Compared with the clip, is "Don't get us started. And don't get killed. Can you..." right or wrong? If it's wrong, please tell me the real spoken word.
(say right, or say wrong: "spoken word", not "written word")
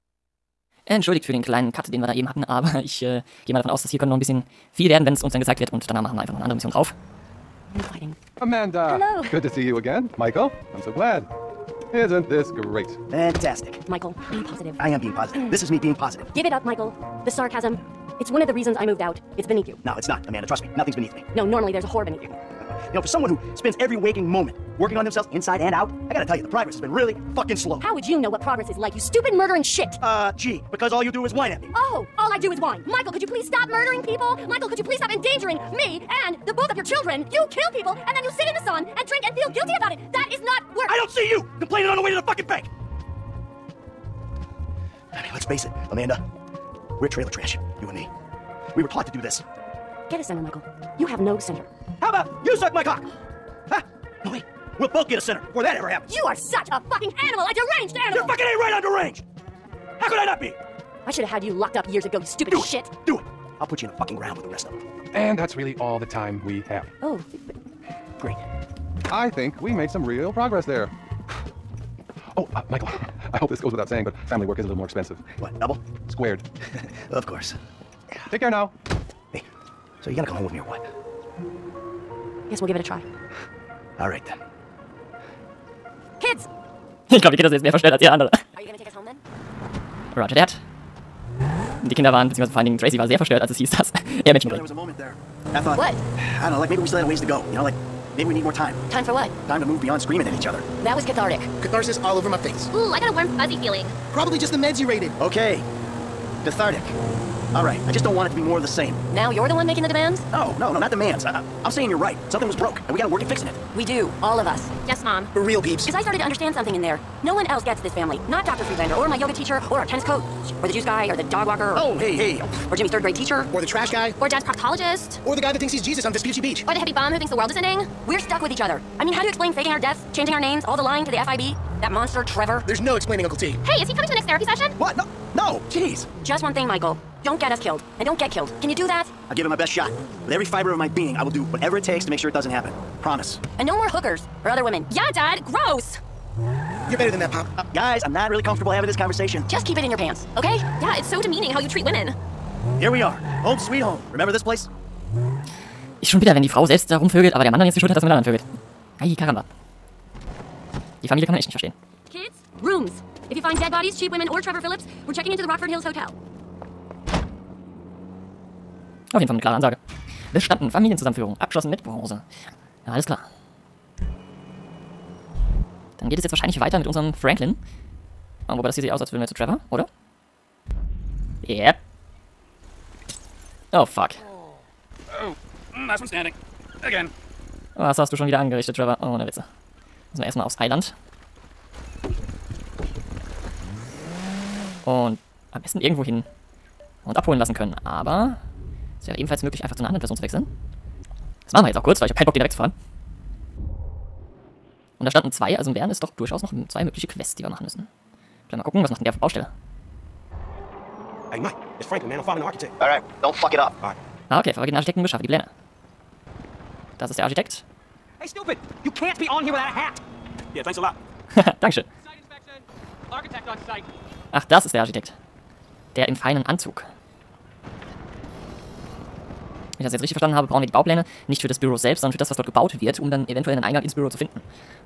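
wrong: "killed", not "started".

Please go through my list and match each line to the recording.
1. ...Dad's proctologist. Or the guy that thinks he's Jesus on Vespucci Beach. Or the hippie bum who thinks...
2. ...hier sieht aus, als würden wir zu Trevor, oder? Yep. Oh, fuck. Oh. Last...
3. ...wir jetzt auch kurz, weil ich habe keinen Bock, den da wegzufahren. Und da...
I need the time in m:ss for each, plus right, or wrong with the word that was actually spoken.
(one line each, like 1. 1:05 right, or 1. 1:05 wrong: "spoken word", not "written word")
1. 2:04 right
2. 2:58 right
3. 3:21 right.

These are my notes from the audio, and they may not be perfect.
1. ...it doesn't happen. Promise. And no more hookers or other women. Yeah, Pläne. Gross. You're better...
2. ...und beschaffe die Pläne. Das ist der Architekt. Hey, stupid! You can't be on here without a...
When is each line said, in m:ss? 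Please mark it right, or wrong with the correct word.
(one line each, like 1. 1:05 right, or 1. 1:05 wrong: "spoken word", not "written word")
1. 2:22 wrong: "Dad", not "Pläne"
2. 3:35 right.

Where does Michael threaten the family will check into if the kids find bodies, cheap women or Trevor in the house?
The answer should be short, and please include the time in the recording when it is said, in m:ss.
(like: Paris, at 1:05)
Rockford Hills Hotel, at 2:45.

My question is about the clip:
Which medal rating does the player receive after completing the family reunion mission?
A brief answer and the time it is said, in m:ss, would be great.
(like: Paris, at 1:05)
Bronze, at 2:51.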